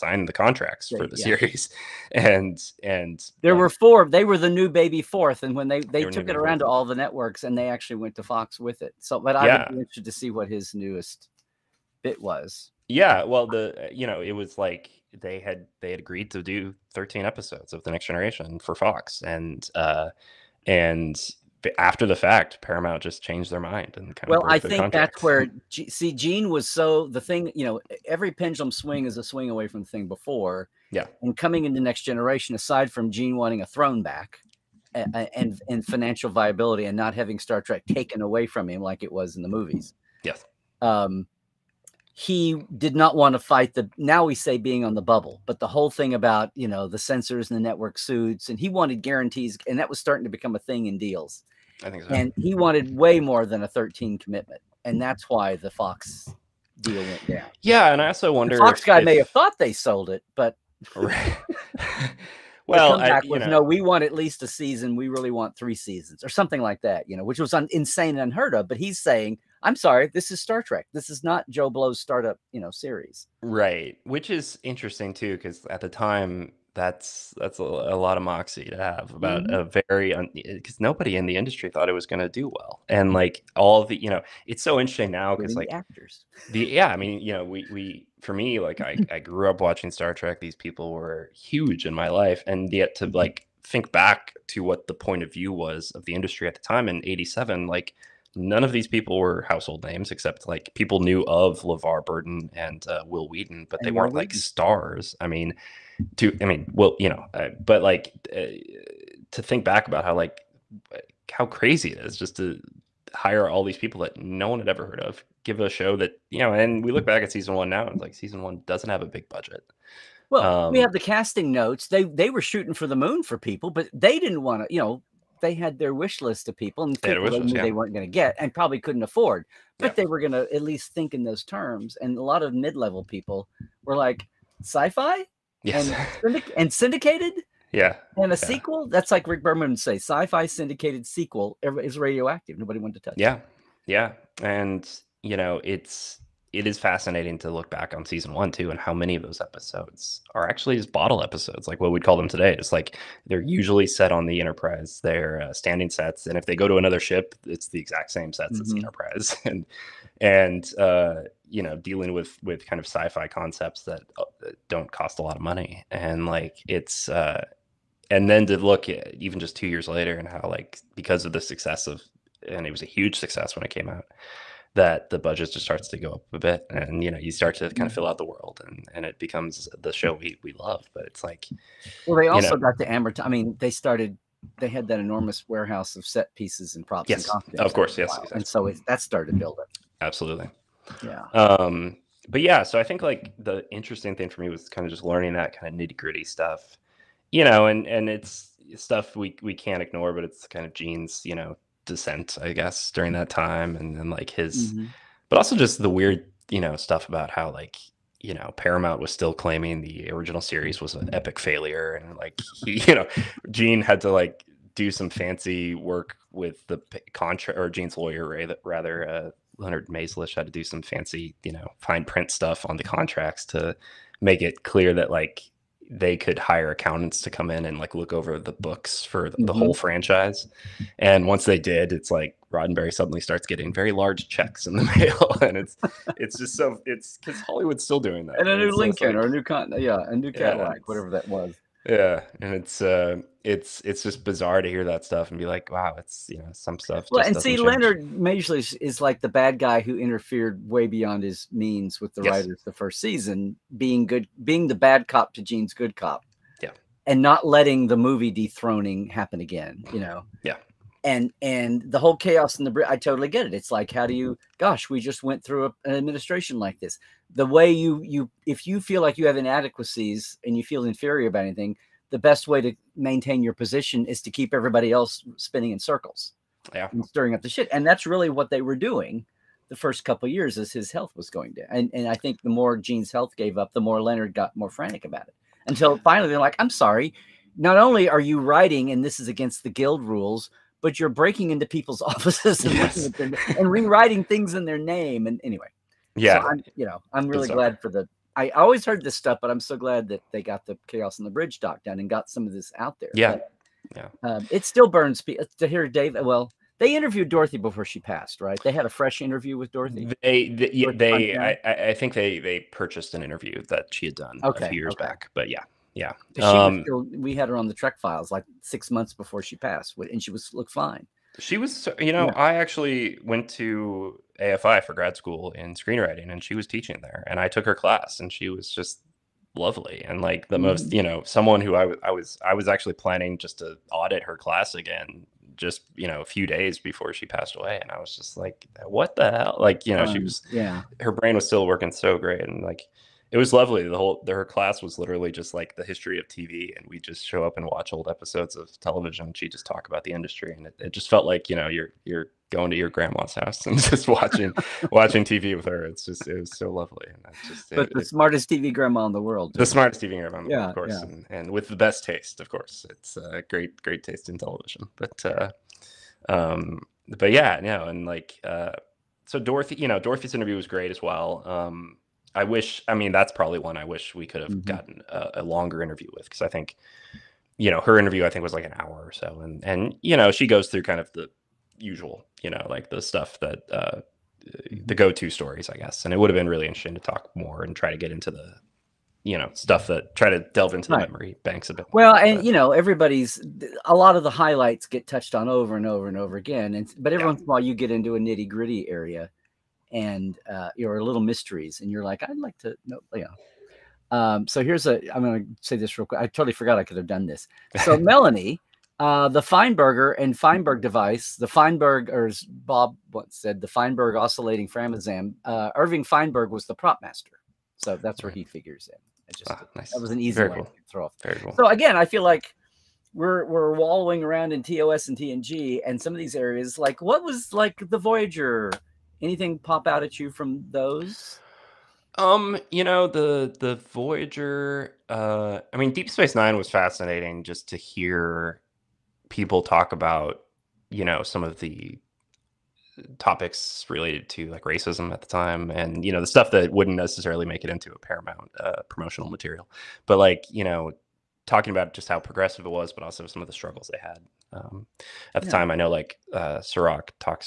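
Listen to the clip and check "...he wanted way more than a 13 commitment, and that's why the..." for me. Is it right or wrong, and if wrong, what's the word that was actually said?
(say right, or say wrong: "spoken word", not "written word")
right.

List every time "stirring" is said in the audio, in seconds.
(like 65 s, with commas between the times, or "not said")
277 s.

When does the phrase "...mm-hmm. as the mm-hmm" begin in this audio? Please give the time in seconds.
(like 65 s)
158 s.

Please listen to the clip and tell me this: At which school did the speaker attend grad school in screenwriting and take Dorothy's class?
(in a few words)
AFI.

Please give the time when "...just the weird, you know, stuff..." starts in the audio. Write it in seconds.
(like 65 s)
205 s.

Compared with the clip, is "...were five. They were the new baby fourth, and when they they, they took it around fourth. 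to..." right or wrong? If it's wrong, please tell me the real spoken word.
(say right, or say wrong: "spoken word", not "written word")
wrong: "four", not "five".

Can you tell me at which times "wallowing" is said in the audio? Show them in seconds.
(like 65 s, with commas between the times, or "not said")
423 s.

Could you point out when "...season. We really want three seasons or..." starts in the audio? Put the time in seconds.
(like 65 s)
64 s.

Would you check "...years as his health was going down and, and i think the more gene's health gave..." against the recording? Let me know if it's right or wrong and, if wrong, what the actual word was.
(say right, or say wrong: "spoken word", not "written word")
right.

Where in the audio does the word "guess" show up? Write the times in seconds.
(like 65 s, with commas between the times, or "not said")
202 s, 385 s.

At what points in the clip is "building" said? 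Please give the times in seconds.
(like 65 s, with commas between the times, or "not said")
189 s.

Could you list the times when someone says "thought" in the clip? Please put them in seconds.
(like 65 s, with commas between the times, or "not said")
59 s, 81 s.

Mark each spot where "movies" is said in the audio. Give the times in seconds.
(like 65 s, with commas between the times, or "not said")
39 s, 257 s.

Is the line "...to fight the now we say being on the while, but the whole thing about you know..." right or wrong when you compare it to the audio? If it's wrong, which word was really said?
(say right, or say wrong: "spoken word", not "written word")
wrong: "bubble", not "while".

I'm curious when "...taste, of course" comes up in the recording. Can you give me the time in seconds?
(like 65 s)
362 s.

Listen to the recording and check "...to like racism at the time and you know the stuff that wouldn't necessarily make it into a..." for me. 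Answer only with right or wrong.
right.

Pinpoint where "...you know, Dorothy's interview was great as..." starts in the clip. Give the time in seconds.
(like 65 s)
369 s.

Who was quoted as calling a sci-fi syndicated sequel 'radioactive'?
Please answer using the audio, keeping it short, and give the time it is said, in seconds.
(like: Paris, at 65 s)
Rick Berman, at 139 s.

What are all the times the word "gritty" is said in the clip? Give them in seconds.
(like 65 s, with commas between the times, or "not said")
195 s, 398 s.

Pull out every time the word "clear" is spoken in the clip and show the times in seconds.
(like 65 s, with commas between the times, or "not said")
224 s.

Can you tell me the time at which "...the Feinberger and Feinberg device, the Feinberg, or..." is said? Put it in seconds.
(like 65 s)
409 s.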